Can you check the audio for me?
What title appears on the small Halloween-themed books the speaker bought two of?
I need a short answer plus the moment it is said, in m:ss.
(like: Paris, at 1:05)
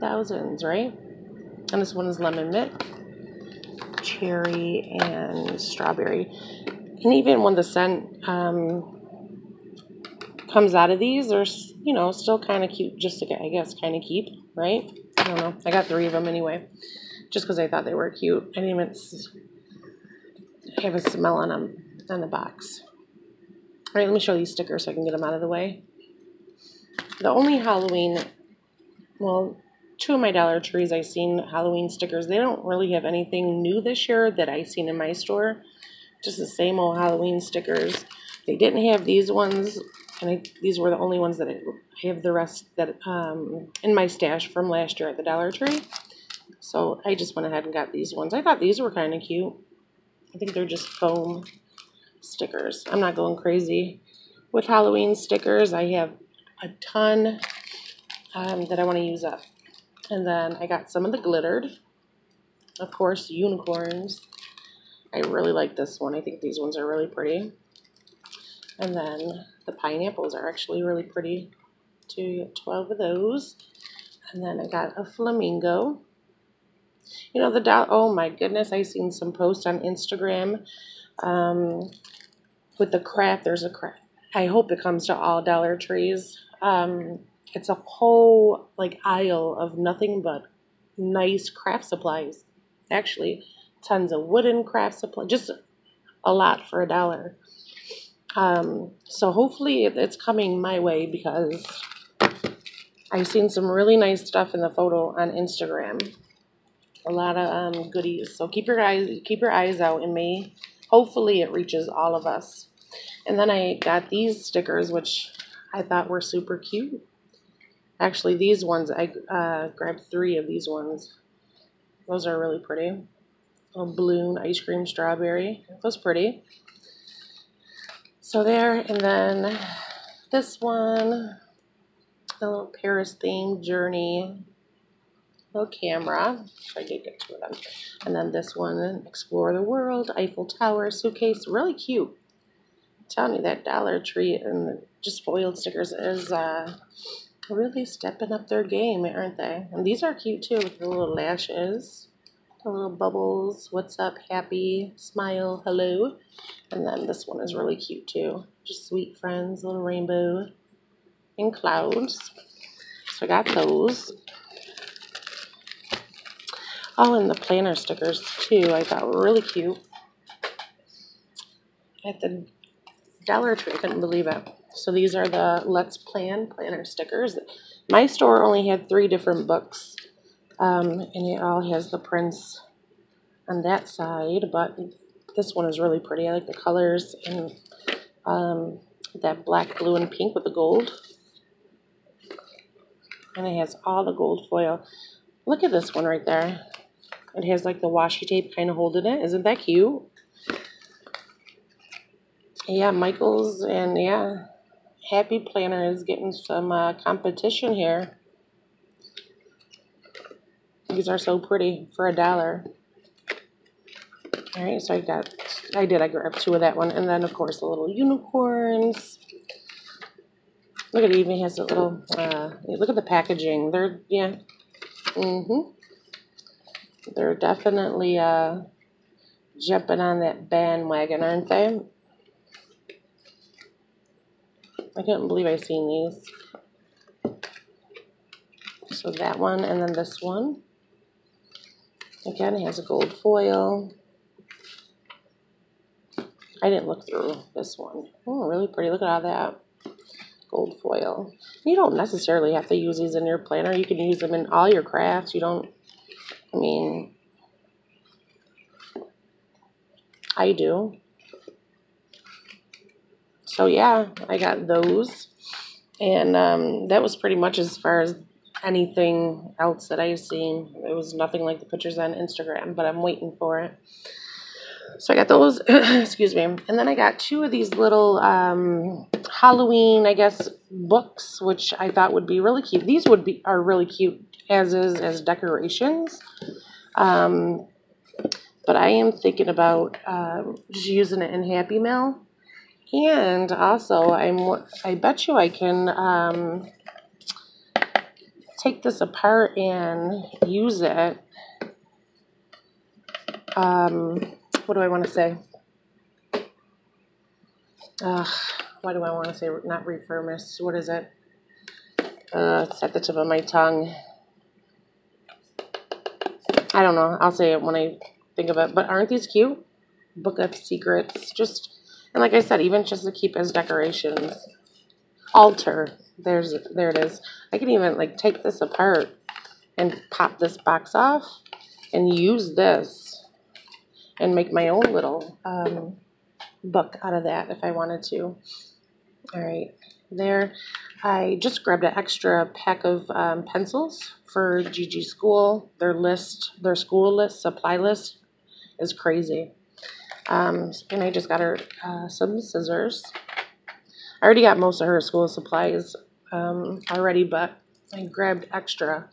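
Book of Secrets, at 5:20.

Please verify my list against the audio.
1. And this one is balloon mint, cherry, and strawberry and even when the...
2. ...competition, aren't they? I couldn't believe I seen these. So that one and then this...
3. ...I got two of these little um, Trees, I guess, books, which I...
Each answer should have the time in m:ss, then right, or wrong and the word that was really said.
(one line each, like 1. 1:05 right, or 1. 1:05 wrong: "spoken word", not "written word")
1. 0:01 wrong: "lemon", not "balloon"
2. 3:50 wrong: "bandwagon", not "competition"
3. 4:36 wrong: "Halloween", not "Trees".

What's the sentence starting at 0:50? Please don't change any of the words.
I think they're just foam stickers.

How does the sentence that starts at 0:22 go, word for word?
All right, let me show these stickers so I can get them out of the way.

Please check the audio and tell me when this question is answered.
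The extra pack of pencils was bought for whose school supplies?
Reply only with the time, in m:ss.
5:44.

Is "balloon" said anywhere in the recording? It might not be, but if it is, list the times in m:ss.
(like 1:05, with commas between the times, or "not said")
2:03.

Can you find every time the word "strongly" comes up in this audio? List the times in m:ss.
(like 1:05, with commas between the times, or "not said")
not said.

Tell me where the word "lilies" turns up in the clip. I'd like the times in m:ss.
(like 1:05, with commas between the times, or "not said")
not said.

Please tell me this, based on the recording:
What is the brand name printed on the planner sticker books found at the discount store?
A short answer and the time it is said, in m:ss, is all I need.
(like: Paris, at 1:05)
Let's Plan, at 2:55.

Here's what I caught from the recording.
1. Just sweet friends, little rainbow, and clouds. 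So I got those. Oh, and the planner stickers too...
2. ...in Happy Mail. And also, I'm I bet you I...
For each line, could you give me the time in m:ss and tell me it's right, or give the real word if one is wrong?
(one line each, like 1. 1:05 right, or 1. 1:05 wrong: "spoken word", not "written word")
1. 2:38 right
2. 4:51 right.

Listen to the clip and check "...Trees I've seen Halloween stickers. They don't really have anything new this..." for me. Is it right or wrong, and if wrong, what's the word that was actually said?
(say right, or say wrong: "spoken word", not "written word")
right.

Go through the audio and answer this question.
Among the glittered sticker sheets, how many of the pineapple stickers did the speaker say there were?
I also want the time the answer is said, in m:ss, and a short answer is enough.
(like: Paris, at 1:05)
12, at 1:12.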